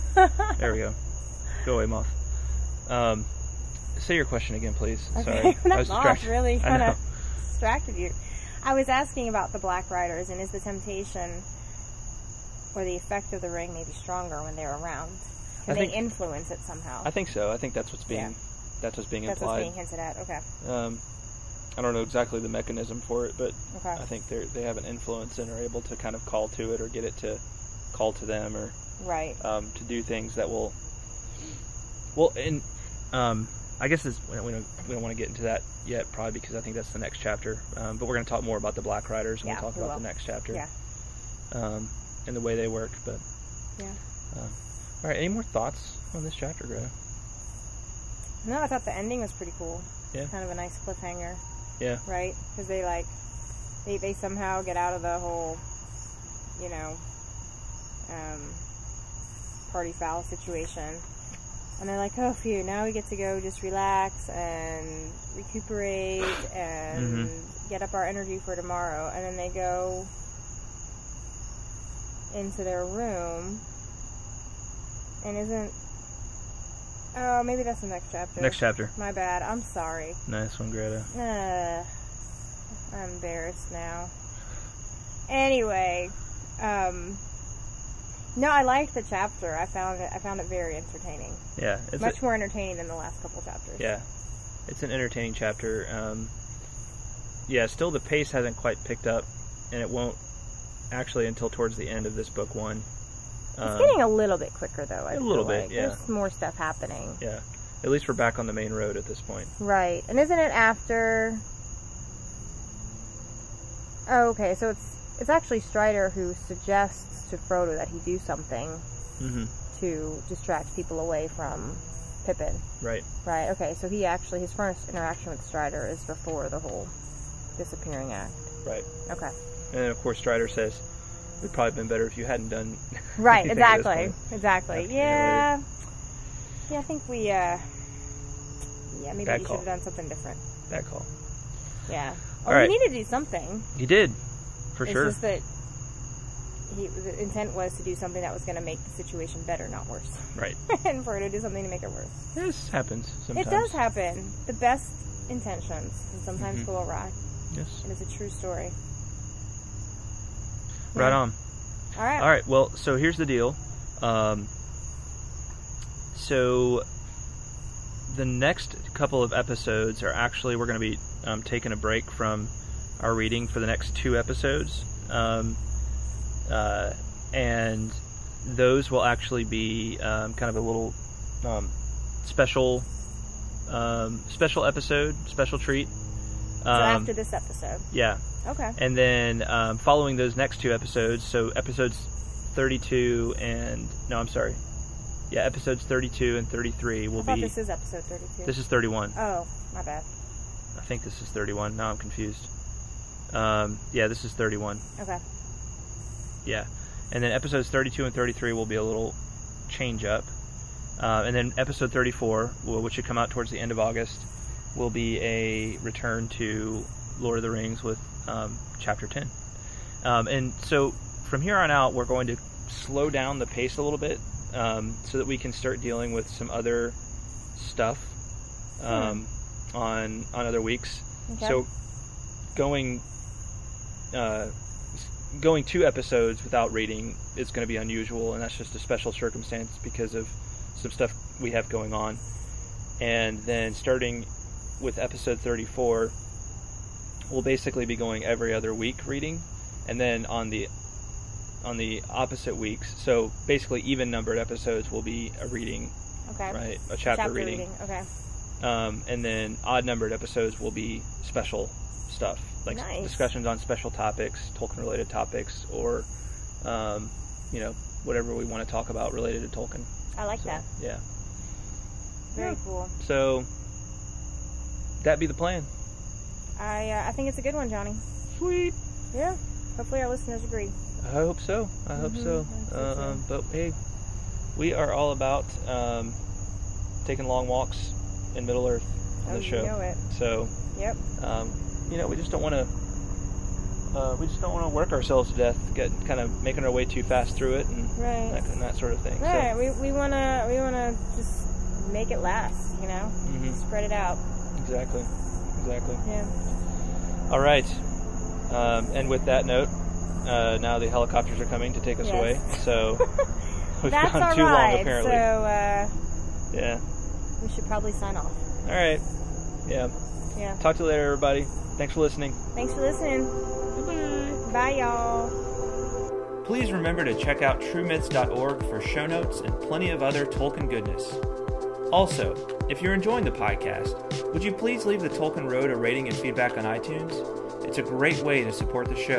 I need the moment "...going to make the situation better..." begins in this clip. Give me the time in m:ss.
2:28.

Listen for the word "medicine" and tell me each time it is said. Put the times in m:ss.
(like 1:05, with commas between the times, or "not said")
not said.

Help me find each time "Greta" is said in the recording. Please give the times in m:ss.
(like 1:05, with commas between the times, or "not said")
0:46, 1:20.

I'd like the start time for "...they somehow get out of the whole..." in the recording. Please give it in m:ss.
0:53.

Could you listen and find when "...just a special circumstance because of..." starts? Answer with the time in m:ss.
3:58.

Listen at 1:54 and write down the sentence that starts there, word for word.
So it's it's actually Strider who suggests to Frodo that he do something mm-hmm.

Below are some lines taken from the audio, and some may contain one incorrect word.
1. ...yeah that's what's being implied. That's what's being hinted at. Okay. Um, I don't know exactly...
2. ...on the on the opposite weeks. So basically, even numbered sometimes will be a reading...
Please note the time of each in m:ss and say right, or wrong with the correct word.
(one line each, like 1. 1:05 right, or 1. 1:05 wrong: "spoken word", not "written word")
1. 0:18 right
2. 4:10 wrong: "episodes", not "sometimes".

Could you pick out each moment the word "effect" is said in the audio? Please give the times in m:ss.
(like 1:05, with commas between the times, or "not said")
0:12.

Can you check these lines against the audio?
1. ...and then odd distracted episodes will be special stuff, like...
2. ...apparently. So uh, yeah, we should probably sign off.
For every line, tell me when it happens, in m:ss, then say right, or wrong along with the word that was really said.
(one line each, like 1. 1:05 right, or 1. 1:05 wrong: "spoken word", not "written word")
1. 4:19 wrong: "numbered", not "distracted"
2. 5:14 right.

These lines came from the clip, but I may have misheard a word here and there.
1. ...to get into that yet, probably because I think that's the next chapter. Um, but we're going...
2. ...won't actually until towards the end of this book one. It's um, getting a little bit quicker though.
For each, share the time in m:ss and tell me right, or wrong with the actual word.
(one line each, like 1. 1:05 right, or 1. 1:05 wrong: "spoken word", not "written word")
1. 0:35 right
2. 1:39 right.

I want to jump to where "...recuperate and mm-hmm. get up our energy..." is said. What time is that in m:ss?
1:05.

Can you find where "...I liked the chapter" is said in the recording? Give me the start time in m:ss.
1:28.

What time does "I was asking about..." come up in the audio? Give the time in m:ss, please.
0:08.